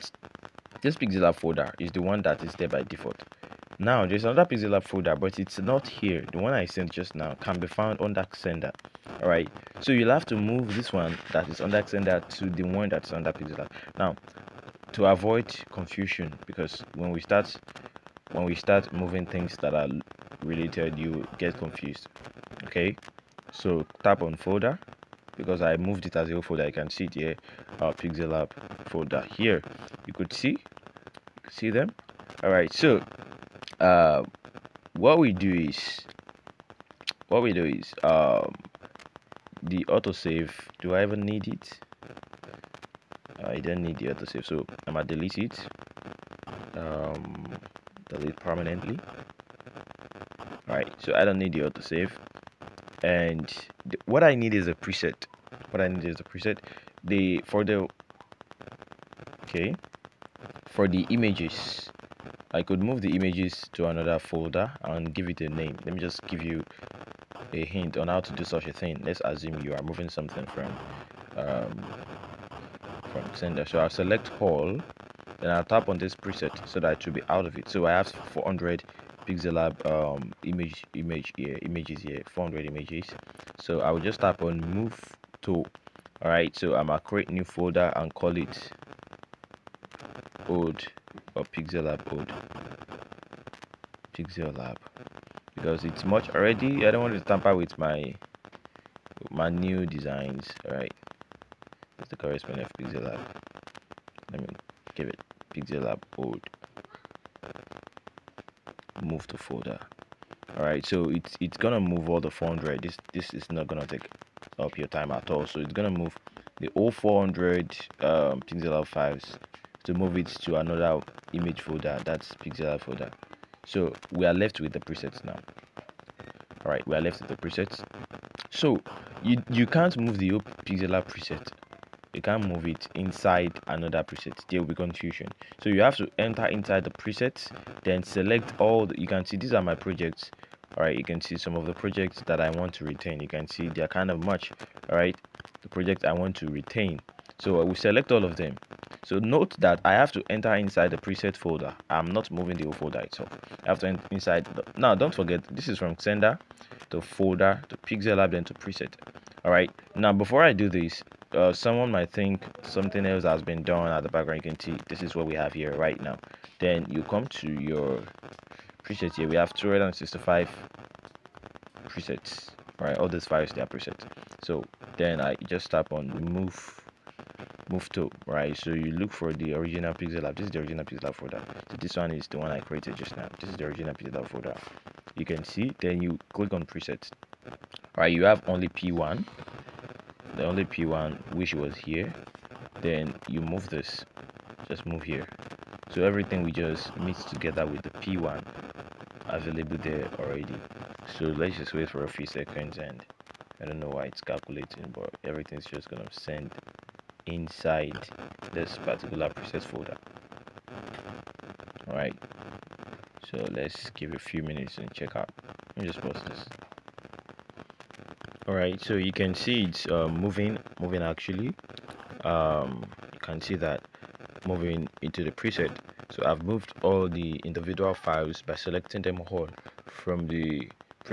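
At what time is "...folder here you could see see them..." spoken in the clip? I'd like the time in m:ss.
0:28.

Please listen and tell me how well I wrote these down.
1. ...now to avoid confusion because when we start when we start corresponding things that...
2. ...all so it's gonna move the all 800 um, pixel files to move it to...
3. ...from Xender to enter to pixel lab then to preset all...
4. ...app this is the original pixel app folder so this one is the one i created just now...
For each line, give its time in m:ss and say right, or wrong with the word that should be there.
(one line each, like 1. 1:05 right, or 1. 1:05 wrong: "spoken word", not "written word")
1. 0:13 wrong: "moving", not "corresponding"
2. 1:55 wrong: "400", not "800"
3. 2:35 wrong: "folder", not "enter"
4. 3:00 right.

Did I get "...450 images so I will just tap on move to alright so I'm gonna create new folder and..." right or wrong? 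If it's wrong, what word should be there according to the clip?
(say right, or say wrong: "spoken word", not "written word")
wrong: "400", not "450".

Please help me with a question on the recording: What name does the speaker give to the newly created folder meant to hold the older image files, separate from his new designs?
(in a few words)
lab old.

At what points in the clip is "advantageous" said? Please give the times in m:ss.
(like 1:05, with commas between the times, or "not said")
not said.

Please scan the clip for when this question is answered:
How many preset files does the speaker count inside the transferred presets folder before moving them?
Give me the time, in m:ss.
2:49.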